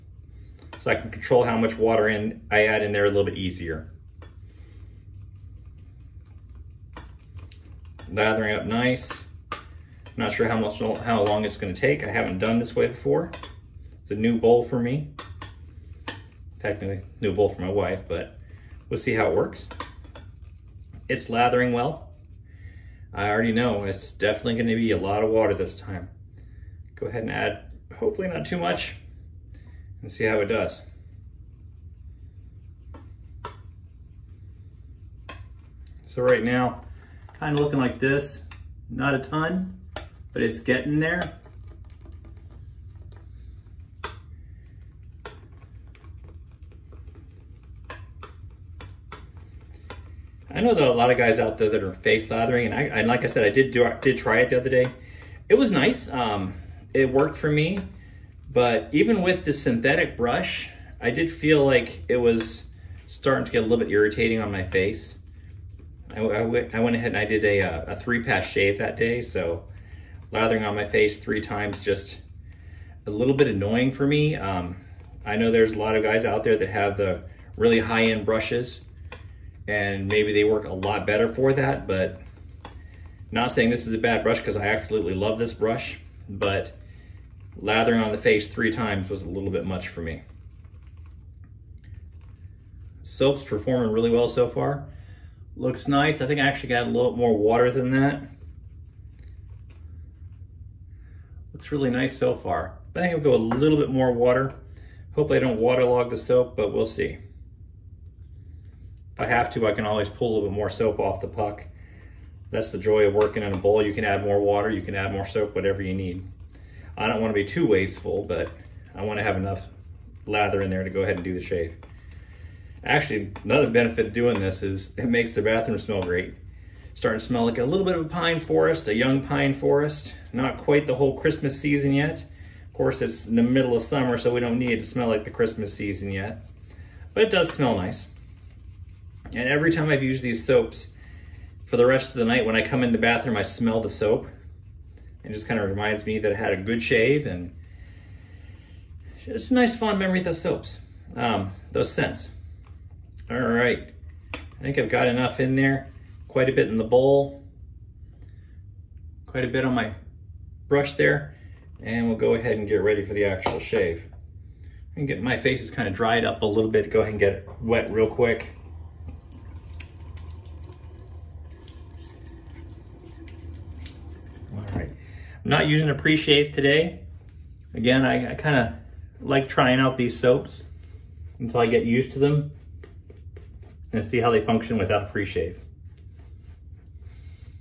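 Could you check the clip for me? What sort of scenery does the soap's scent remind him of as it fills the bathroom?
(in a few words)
a young pine forest.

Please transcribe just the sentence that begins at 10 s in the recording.
not sure how much how long it's going to take.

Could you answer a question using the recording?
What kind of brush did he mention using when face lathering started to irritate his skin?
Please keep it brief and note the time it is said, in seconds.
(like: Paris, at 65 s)
synthetic brush, at 59 s.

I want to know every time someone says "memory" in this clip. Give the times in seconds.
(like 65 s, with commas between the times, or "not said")
149 s.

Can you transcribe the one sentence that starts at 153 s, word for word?
All right, I think I've got enough in there.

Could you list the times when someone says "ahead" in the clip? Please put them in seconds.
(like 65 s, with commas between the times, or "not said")
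27 s, 66 s, 121 s, 162 s, 167 s.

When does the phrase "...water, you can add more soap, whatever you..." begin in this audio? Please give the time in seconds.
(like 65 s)
114 s.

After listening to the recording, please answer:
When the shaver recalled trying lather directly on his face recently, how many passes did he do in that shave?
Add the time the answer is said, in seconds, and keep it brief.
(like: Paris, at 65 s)
3, at 67 s.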